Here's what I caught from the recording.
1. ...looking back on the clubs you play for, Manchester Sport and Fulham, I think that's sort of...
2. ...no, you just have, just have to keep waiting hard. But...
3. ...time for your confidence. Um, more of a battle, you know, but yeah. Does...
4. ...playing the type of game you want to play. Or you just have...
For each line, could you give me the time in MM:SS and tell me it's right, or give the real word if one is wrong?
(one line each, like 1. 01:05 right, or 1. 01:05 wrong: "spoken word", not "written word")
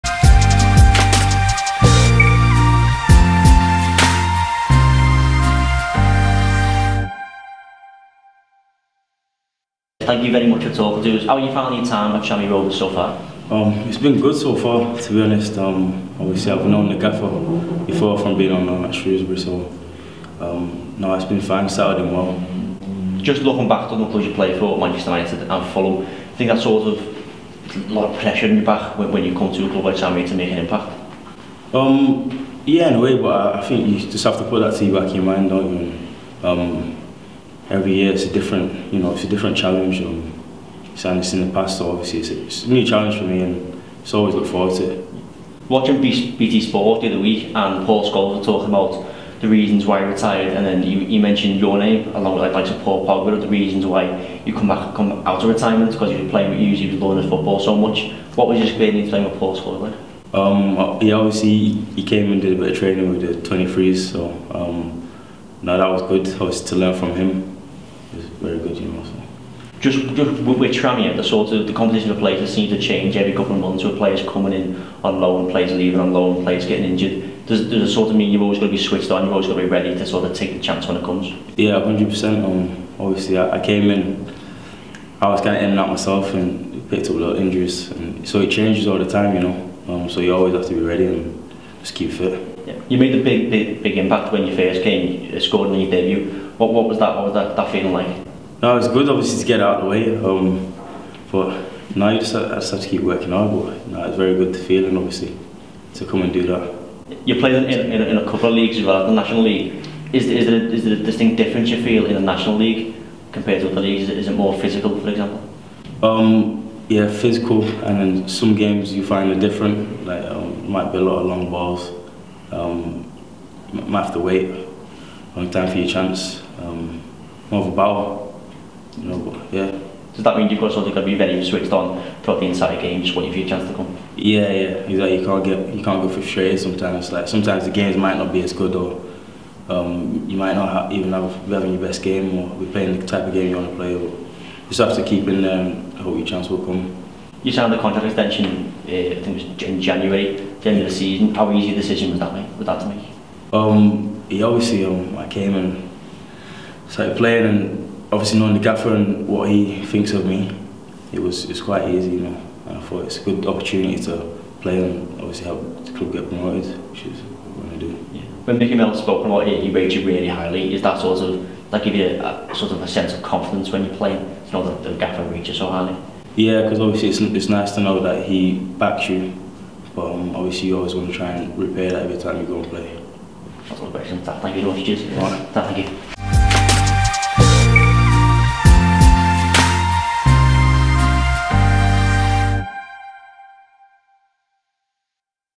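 1. 00:23 wrong: "United", not "Sport"
2. 01:41 wrong: "working", not "waiting"
3. 02:05 wrong: "chance", not "confidence"
4. 02:22 right.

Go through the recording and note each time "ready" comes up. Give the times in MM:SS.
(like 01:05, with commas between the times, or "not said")
01:19, 01:30.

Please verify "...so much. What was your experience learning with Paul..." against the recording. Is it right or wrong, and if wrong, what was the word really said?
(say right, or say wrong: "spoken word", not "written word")
wrong: "playing", not "learning".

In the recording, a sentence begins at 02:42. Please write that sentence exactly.
And I thought it's a good opportunity to play and obviously help the club get promoted, which is what I do.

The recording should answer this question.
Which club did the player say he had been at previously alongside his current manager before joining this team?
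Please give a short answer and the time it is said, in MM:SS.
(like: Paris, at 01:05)
Shrewsbury, at 00:18.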